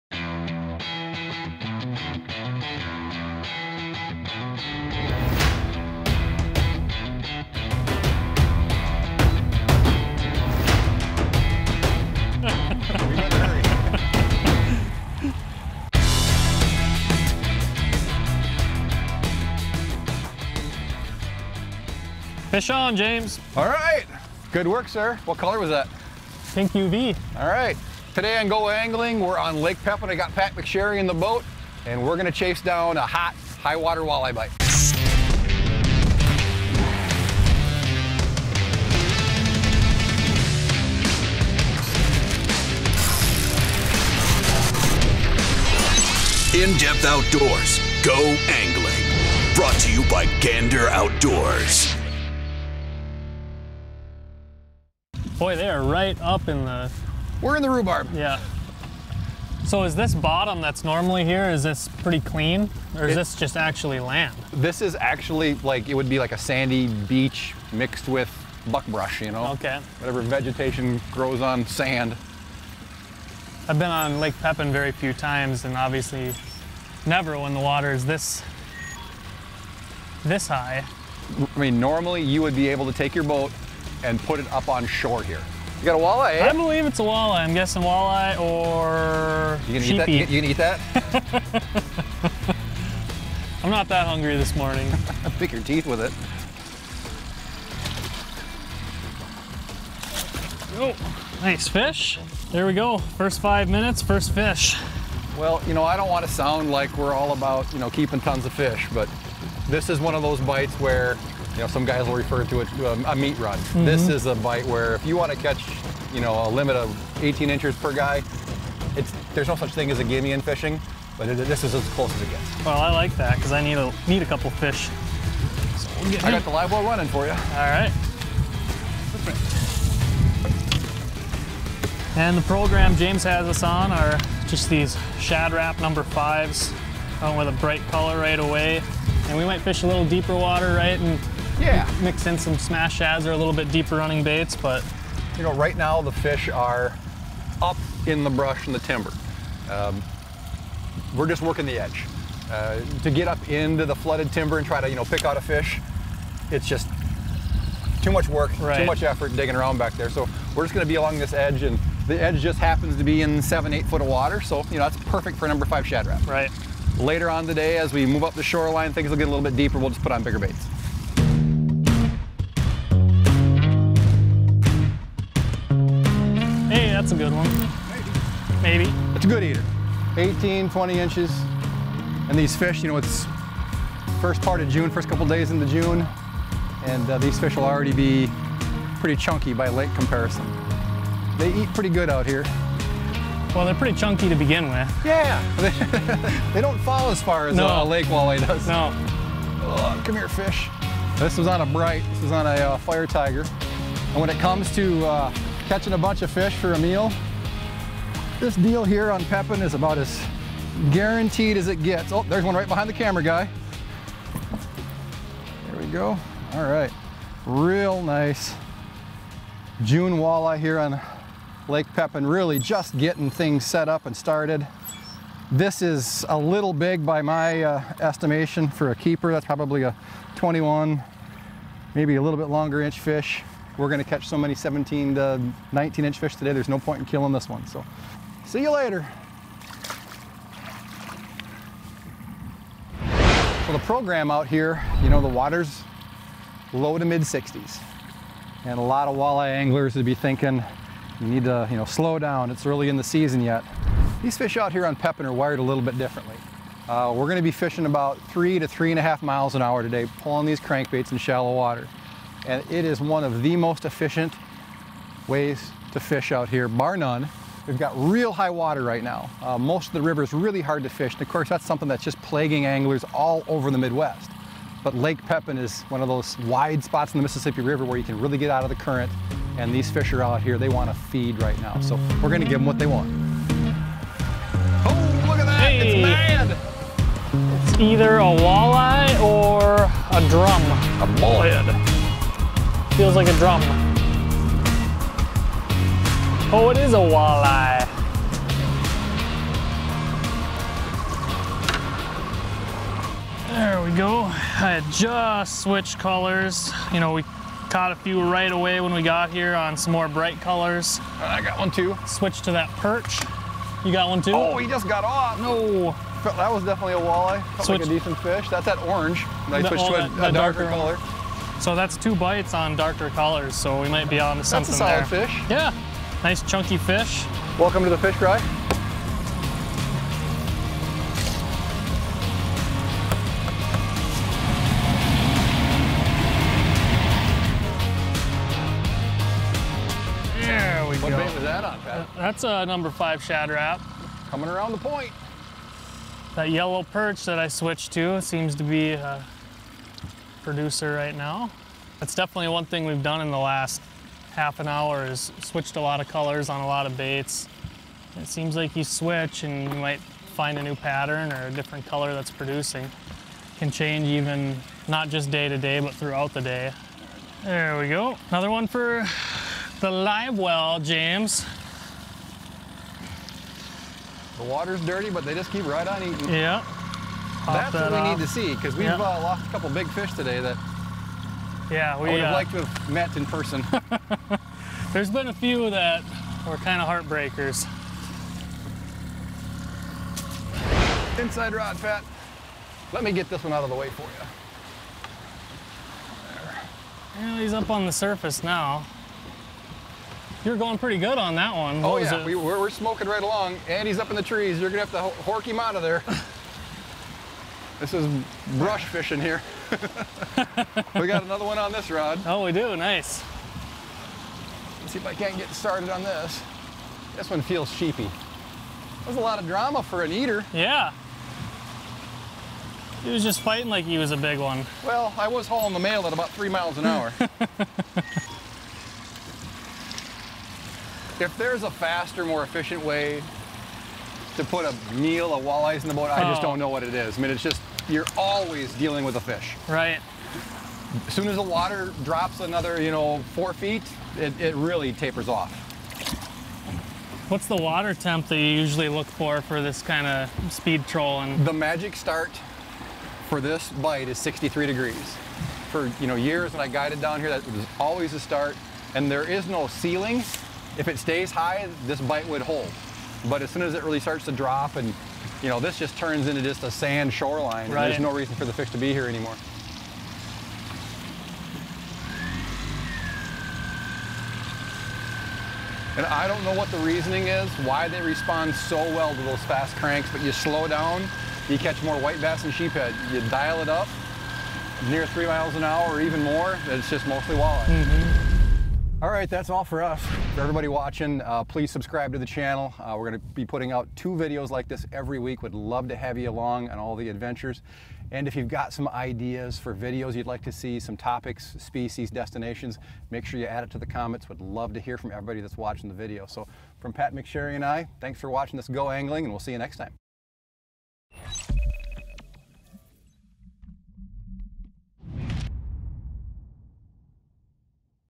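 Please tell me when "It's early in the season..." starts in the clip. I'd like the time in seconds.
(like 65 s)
252 s.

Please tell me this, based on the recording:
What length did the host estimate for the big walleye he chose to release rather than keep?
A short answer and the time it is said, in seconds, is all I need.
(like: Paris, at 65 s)
21 inches, at 230 s.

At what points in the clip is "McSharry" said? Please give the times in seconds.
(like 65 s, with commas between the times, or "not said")
30 s, 507 s.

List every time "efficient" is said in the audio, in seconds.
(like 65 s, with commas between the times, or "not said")
263 s, 432 s.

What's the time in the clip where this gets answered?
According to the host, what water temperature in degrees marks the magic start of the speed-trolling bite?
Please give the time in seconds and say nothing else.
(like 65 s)
454 s.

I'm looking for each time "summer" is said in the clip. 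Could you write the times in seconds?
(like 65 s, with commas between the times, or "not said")
not said.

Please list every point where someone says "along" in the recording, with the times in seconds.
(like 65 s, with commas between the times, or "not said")
160 s, 403 s, 496 s.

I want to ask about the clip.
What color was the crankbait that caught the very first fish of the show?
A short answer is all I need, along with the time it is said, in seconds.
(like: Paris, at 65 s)
Pink UV, at 26 s.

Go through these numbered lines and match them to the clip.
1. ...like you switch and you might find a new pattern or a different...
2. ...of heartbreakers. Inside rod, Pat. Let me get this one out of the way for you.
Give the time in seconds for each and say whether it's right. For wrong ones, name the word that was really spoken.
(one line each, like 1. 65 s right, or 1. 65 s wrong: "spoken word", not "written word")
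1. 358 s right
2. 386 s right.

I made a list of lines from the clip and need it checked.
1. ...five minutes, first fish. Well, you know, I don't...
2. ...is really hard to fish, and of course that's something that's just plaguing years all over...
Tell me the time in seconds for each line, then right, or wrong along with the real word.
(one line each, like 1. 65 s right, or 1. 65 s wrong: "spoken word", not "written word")
1. 103 s right
2. 270 s wrong: "anglers", not "years".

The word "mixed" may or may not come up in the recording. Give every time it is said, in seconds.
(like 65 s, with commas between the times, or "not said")
67 s.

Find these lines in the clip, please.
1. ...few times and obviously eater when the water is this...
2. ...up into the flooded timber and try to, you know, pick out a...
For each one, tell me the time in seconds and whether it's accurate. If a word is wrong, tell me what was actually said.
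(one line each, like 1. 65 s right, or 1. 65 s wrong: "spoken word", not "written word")
1. 74 s wrong: "never", not "eater"
2. 153 s right.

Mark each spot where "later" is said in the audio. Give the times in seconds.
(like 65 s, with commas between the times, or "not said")
166 s, 238 s.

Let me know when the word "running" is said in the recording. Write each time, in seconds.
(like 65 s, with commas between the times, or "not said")
126 s, 143 s.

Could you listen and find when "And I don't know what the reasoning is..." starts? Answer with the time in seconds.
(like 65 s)
475 s.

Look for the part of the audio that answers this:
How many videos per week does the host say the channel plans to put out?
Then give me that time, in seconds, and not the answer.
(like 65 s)
493 s.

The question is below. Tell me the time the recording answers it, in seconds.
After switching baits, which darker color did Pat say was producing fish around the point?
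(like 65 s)
346 s.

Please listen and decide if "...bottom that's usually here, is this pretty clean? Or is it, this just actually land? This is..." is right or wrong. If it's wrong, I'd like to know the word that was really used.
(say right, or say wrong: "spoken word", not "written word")
wrong: "normally", not "usually".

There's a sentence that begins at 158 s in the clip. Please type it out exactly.
too much effort digging around back there.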